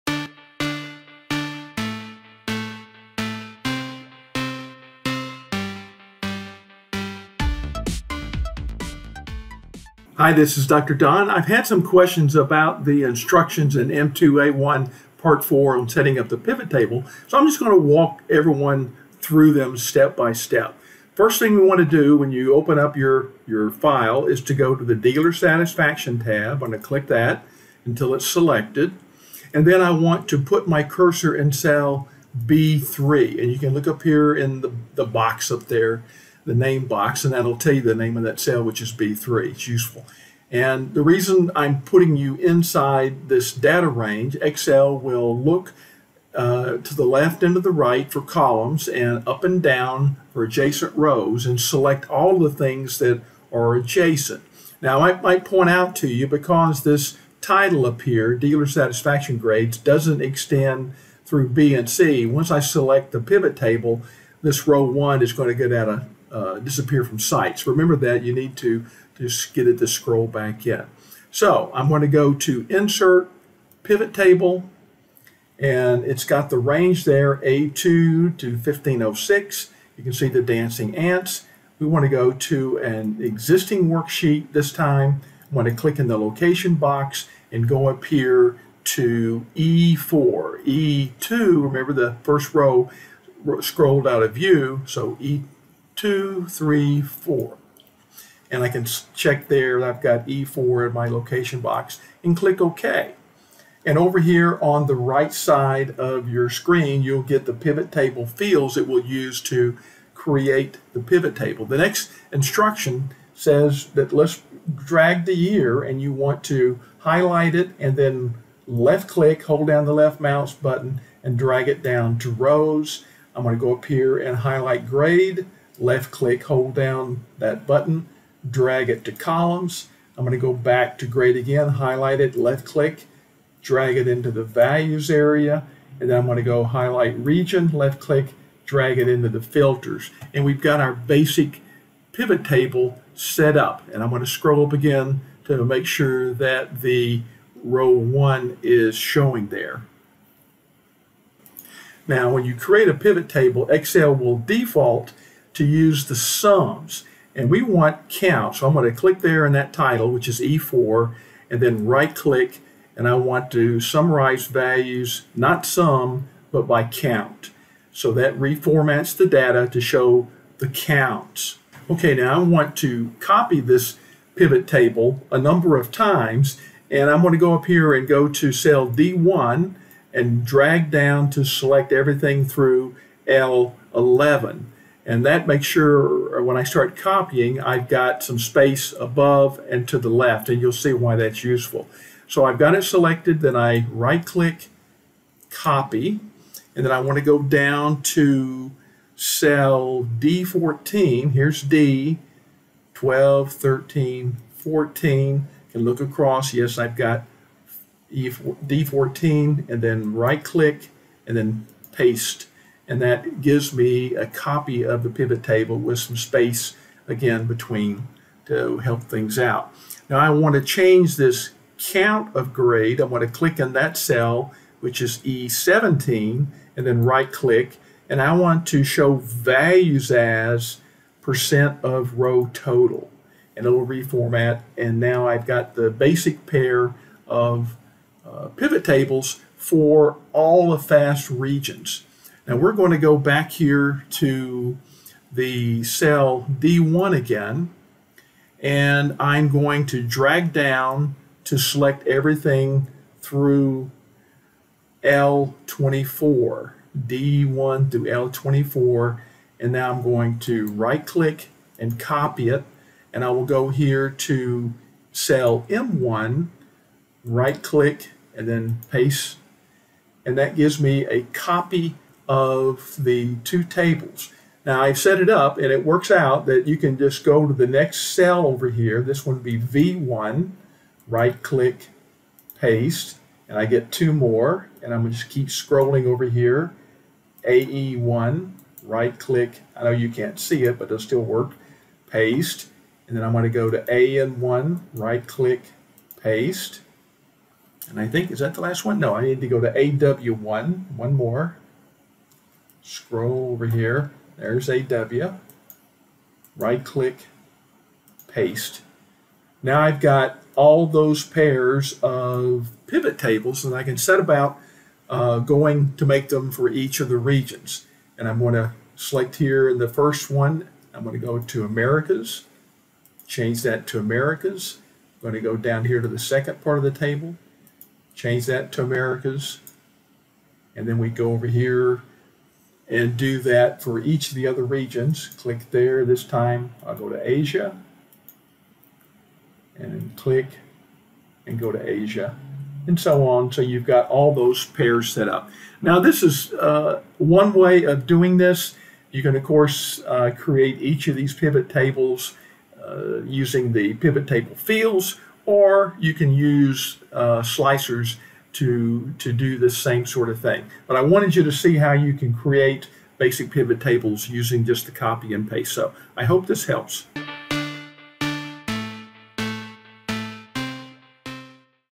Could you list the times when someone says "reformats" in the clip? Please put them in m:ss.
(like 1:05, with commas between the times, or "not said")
2:48, 3:53.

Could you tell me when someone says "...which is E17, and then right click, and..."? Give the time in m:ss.
3:44.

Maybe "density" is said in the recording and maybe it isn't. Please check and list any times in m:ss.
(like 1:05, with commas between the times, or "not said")
not said.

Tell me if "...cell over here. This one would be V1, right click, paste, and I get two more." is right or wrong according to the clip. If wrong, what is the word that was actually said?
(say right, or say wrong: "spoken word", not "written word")
right.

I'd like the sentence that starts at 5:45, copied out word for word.
Now this is uh, one way of doing this.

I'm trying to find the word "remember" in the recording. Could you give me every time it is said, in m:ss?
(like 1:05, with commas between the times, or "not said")
1:07, 1:31.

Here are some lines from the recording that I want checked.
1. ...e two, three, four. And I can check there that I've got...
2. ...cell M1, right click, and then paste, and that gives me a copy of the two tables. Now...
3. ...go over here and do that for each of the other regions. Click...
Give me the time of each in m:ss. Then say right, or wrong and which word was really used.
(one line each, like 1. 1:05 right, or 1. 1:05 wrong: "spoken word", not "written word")
1. 1:35 right
2. 4:25 right
3. 5:31 right.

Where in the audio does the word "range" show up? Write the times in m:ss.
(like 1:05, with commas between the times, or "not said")
0:43, 1:16.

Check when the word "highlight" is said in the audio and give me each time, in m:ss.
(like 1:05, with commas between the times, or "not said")
1:56, 2:04, 2:11, 2:16.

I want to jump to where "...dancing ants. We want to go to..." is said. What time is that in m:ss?
1:20.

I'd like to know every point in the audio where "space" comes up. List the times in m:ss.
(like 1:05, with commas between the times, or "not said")
3:08, 3:36.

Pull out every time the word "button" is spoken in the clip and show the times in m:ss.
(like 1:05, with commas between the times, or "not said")
2:00, 2:07.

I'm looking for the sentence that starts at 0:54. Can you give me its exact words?
Now, I might point out to you because this title up here, Dealer Satisfaction Grades, doesn't extend through B and C.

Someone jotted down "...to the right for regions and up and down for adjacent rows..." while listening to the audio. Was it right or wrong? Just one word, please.
wrong.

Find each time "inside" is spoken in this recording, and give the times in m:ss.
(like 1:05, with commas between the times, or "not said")
0:42.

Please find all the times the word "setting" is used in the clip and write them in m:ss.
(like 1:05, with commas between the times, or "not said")
0:15.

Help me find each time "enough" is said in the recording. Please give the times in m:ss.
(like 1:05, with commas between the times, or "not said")
not said.